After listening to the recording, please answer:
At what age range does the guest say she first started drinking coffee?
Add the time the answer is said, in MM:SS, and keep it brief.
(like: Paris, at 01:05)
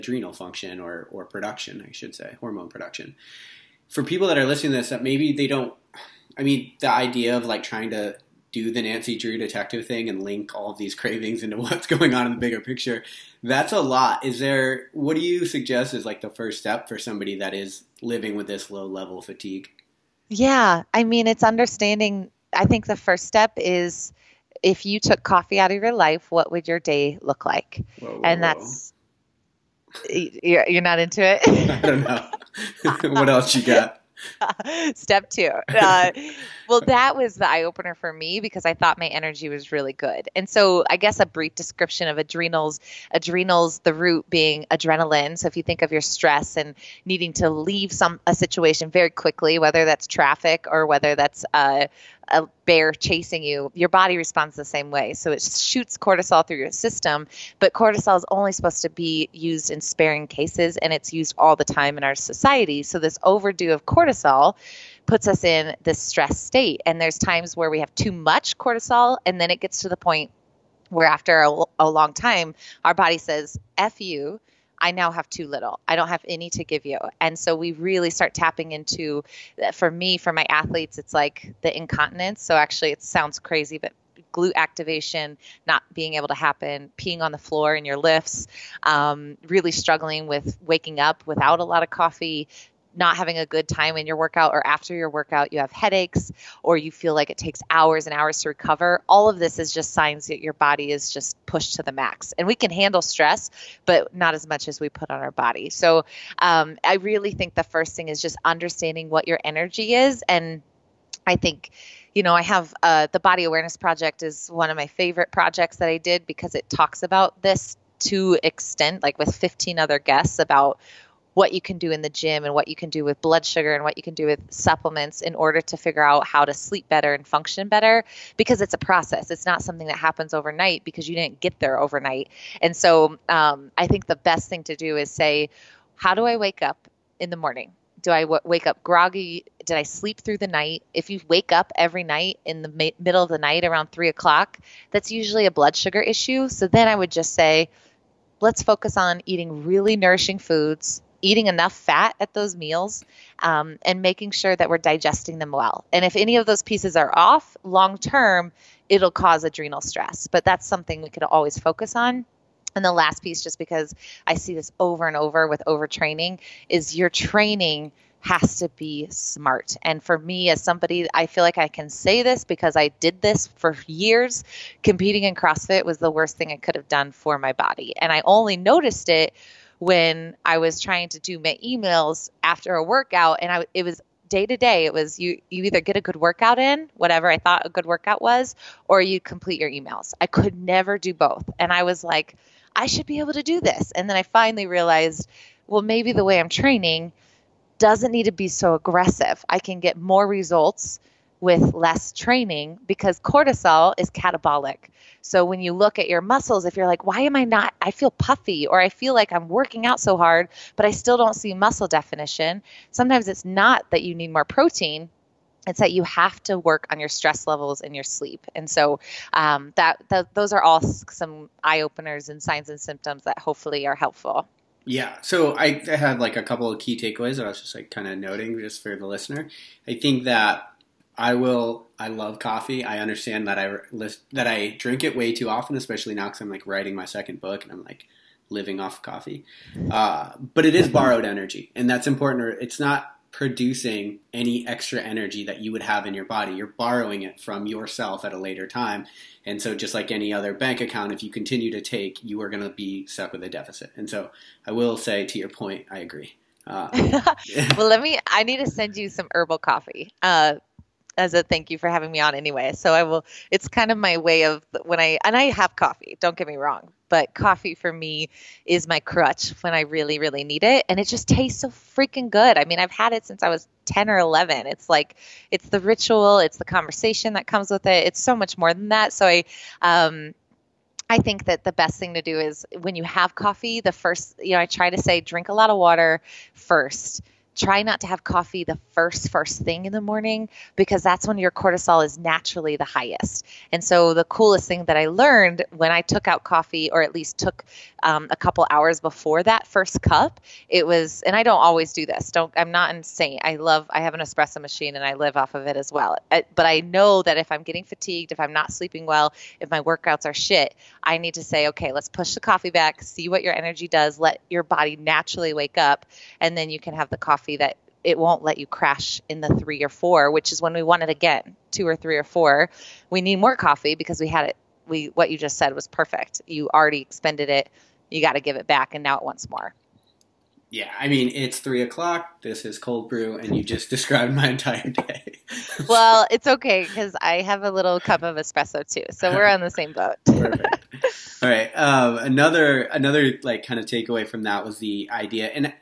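10 or 11, at 04:33.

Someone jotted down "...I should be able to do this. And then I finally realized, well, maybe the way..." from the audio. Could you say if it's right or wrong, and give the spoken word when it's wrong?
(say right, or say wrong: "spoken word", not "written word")
right.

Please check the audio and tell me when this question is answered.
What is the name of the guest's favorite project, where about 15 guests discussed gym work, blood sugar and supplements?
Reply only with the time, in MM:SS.
01:53.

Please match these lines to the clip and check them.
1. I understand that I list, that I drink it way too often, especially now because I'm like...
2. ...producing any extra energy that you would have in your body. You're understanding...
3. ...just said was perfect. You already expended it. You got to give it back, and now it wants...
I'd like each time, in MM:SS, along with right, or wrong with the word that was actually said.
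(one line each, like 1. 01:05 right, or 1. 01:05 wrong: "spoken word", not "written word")
1. 03:52 right
2. 04:03 wrong: "borrowing", not "understanding"
3. 05:25 right.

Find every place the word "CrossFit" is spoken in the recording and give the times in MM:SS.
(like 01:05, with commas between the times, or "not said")
02:55.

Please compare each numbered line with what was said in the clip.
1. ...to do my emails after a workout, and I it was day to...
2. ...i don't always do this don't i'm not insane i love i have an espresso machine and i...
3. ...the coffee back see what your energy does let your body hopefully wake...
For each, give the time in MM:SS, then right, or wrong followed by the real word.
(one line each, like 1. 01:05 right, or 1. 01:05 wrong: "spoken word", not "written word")
1. 03:01 right
2. 05:01 right
3. 05:12 wrong: "naturally", not "hopefully".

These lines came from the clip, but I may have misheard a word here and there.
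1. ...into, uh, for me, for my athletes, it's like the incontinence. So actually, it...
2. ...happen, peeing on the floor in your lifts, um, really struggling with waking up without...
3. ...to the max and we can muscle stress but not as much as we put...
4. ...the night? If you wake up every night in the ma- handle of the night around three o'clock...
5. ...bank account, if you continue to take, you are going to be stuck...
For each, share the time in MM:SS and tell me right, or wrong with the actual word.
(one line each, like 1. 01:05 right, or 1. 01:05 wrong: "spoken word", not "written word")
1. 01:18 right
2. 01:26 right
3. 01:41 wrong: "handle", not "muscle"
4. 02:20 wrong: "middle", not "handle"
5. 04:10 right.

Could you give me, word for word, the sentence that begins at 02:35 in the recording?
And if any of those pieces are off long term, it'll cause adrenal stress.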